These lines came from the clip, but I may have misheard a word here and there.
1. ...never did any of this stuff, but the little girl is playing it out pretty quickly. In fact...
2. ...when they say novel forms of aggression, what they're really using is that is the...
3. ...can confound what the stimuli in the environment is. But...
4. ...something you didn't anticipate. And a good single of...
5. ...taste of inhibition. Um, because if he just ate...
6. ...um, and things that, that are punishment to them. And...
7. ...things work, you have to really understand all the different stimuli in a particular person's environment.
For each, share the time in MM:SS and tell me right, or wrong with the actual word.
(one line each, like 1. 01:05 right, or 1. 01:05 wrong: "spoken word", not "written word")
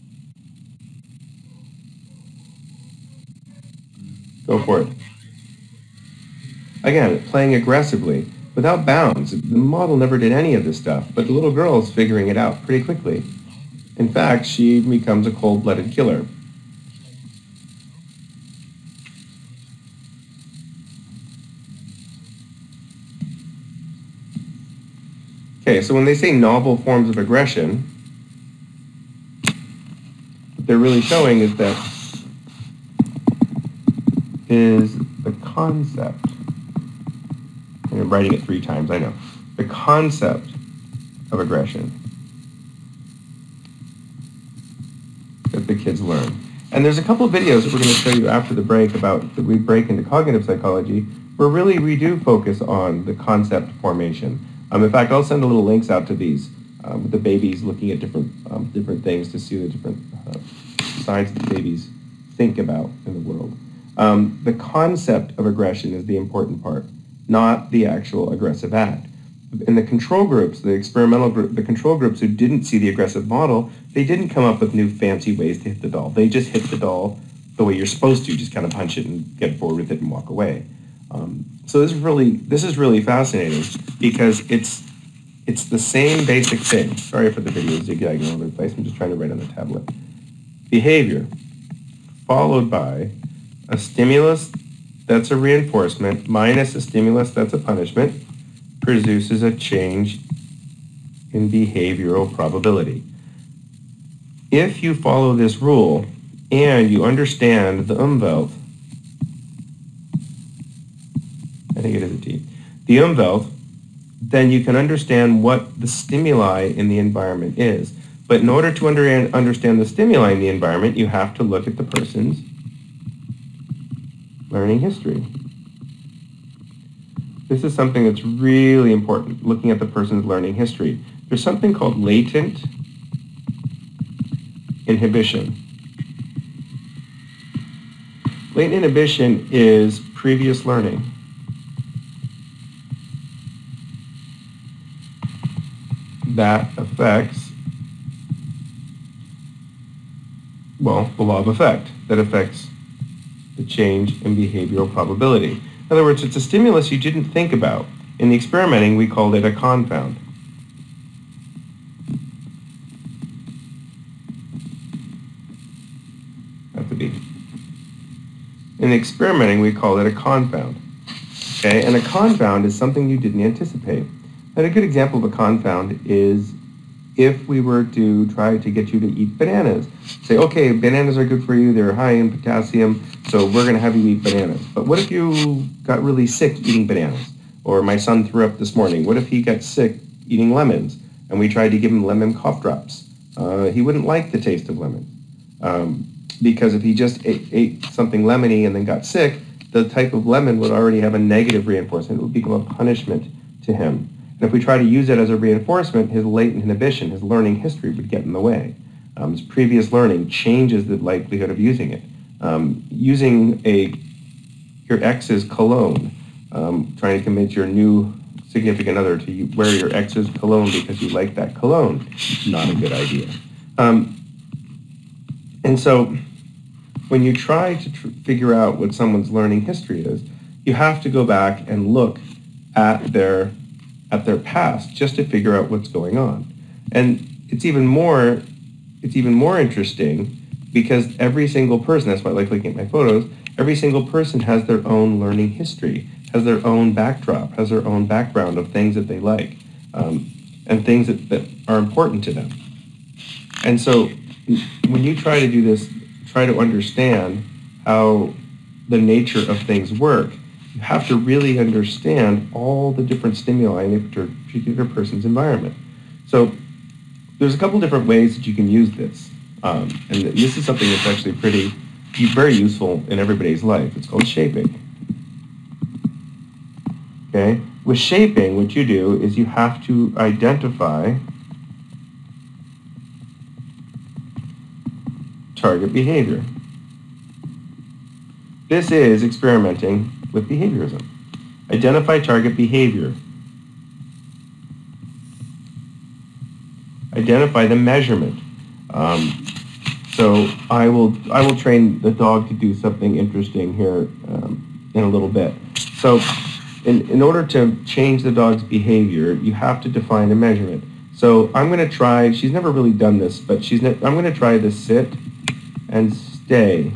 1. 00:09 wrong: "figuring", not "playing"
2. 00:25 wrong: "showing", not "using"
3. 01:54 wrong: "understand", not "confound"
4. 02:52 wrong: "example", not "single"
5. 03:14 wrong: "lemon", not "inhibition"
6. 04:09 wrong: "important", not "punishment"
7. 04:19 right.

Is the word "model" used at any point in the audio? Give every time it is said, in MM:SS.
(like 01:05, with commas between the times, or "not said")
00:09, 01:13.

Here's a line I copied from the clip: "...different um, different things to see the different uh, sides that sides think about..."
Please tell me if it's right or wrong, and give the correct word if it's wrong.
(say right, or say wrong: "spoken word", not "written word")
wrong: "babies", not "sides".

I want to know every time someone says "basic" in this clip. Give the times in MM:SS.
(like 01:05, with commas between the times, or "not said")
01:26.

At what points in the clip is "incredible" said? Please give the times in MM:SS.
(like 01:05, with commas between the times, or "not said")
not said.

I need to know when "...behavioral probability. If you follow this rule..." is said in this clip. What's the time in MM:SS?
01:41.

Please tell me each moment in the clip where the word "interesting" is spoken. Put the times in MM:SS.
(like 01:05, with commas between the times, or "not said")
03:59, 05:03.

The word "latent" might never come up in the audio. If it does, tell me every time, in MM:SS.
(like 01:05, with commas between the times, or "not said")
02:11, 02:18, 03:26.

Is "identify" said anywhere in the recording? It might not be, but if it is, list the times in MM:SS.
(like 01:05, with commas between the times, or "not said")
04:40, 04:51, 04:57.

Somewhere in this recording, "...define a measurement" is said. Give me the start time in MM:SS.
05:09.